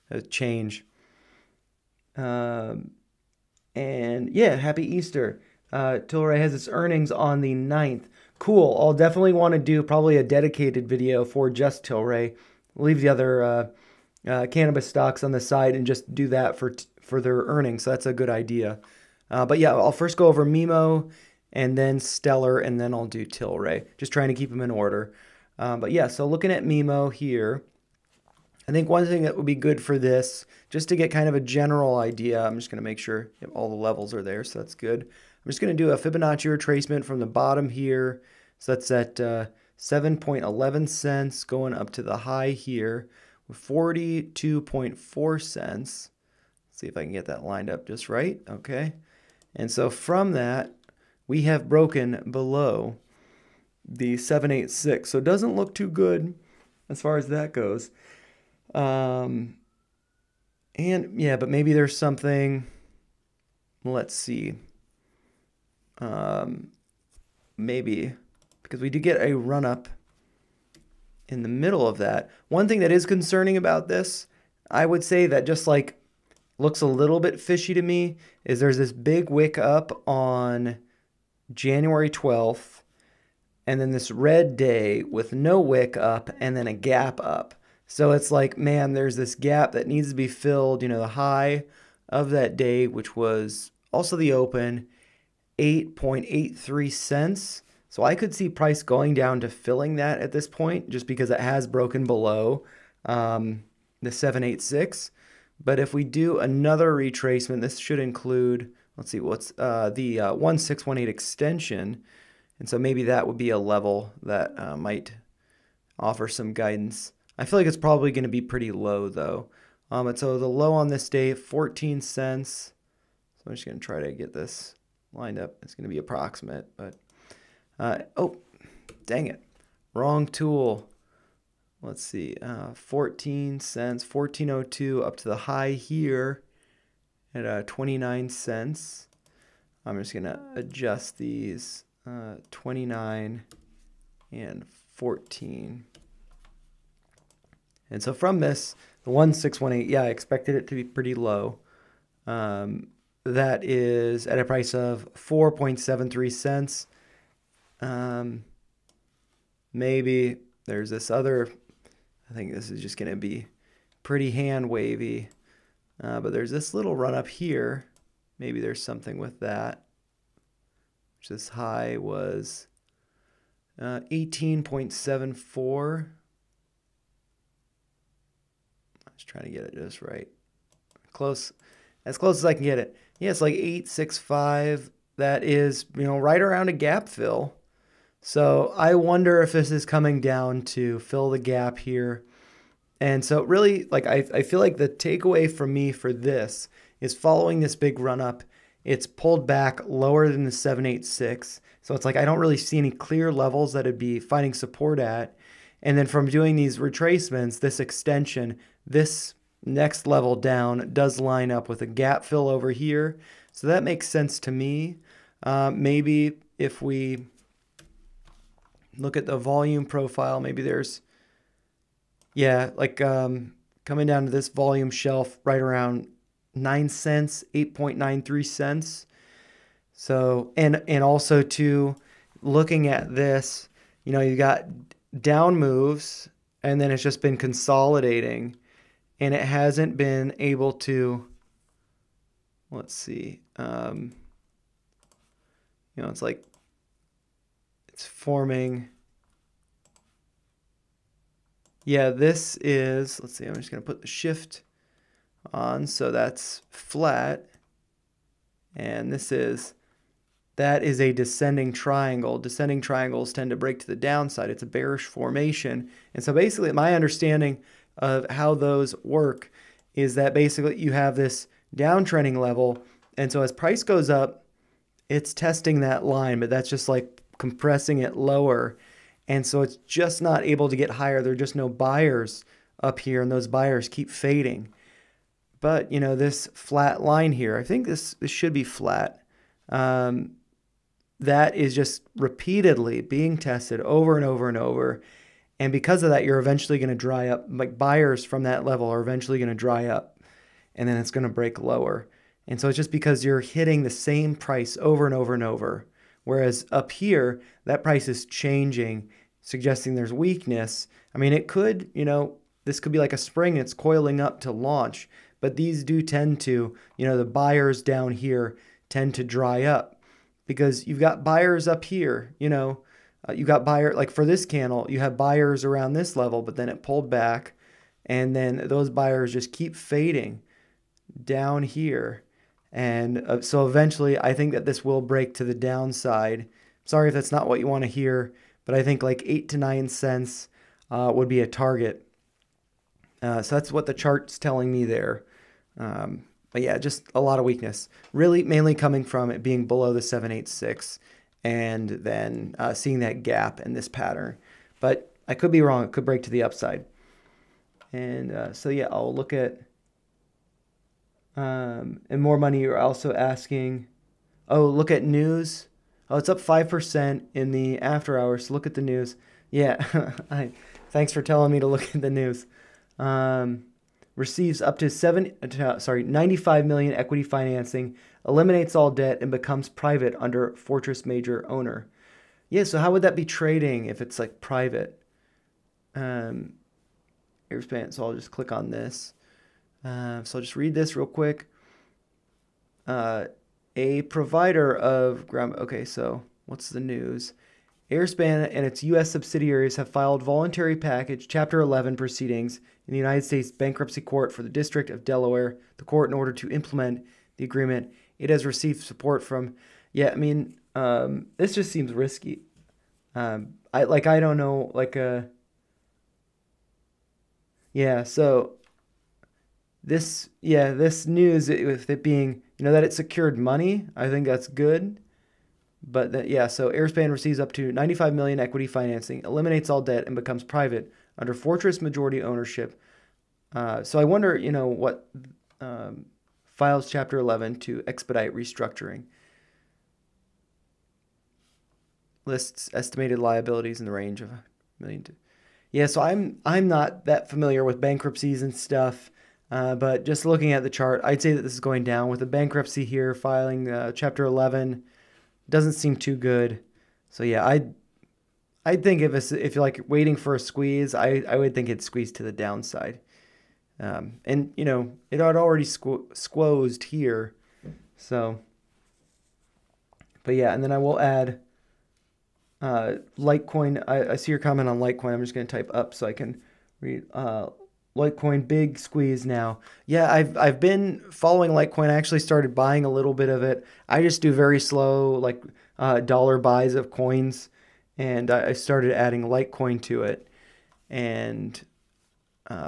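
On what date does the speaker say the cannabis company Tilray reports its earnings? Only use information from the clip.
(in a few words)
the 9th.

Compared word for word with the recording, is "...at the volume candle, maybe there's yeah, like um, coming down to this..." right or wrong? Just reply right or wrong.
wrong.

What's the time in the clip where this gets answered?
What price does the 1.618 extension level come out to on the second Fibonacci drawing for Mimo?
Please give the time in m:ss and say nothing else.
2:35.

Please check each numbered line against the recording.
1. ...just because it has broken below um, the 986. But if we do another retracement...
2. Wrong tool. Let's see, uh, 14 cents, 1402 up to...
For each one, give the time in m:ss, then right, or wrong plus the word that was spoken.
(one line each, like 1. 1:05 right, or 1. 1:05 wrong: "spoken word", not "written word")
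1. 1:40 wrong: "786", not "986"
2. 2:09 right.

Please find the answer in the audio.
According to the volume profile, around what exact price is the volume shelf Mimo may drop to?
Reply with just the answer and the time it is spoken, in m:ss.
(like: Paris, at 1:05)
8.93 cents, at 3:47.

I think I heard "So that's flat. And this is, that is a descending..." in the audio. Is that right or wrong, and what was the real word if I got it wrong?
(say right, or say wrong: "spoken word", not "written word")
right.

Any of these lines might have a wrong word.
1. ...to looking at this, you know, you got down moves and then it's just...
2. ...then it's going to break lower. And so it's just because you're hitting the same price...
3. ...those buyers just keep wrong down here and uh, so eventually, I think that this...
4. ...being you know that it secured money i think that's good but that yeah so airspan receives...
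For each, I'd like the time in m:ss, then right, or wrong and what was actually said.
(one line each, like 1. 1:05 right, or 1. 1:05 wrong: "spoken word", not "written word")
1. 3:51 right
2. 5:00 right
3. 5:28 wrong: "fading", not "wrong"
4. 7:02 right.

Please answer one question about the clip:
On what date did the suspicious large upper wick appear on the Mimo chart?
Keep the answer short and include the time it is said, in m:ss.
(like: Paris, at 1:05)
January 12th, at 1:21.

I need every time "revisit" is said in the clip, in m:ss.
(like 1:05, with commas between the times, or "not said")
not said.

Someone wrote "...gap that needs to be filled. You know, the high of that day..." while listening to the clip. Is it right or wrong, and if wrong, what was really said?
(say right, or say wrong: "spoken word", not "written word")
right.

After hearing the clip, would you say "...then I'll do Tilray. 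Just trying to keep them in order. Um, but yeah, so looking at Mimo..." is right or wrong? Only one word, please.
right.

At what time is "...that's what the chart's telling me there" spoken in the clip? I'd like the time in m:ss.
5:43.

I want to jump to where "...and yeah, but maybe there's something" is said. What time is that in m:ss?
1:00.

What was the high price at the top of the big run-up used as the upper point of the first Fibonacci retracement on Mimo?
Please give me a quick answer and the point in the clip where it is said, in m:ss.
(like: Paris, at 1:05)
42.4 cents, at 0:43.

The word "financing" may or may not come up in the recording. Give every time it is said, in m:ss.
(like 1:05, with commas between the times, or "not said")
6:17, 7:08.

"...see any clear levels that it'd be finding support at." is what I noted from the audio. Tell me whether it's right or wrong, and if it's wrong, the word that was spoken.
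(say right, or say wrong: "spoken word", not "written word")
right.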